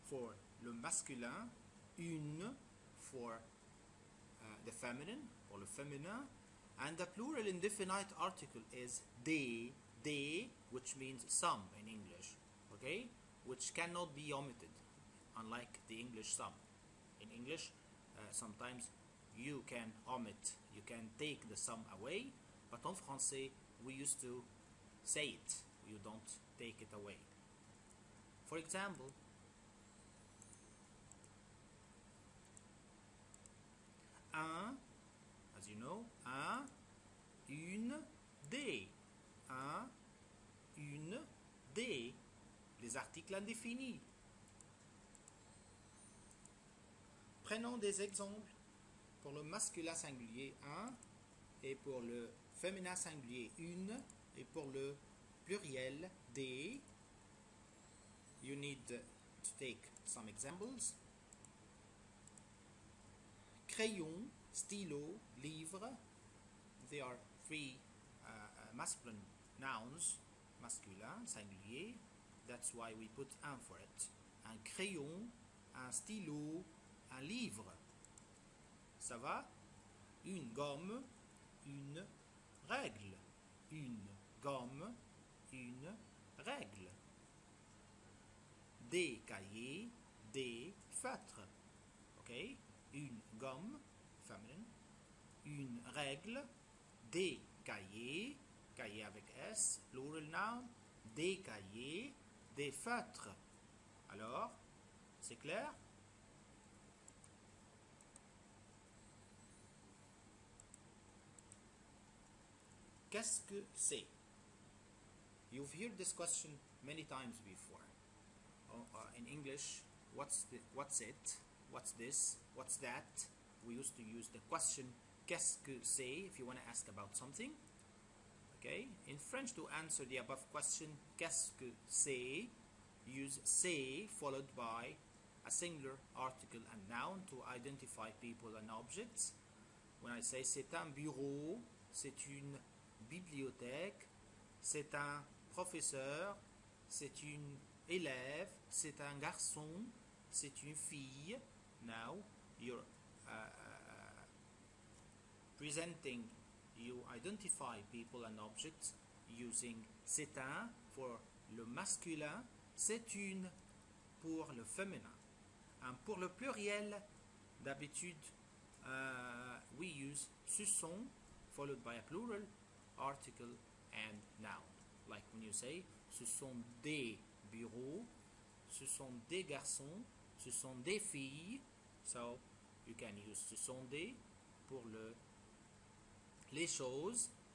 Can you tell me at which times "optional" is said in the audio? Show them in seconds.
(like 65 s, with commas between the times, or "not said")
not said.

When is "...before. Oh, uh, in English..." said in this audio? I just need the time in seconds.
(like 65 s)
117 s.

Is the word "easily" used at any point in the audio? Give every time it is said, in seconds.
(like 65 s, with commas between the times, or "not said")
not said.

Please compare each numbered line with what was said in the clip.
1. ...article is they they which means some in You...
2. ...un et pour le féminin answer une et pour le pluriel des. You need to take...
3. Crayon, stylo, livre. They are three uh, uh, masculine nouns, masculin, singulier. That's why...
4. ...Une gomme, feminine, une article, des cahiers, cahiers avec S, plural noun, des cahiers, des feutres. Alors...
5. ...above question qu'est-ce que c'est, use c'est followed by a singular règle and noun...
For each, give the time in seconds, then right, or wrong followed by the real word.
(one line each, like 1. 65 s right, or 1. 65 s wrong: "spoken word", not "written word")
1. 8 s wrong: "English", not "You"
2. 50 s wrong: "singulier", not "answer"
3. 63 s right
4. 92 s wrong: "règle", not "article"
5. 130 s wrong: "article", not "règle".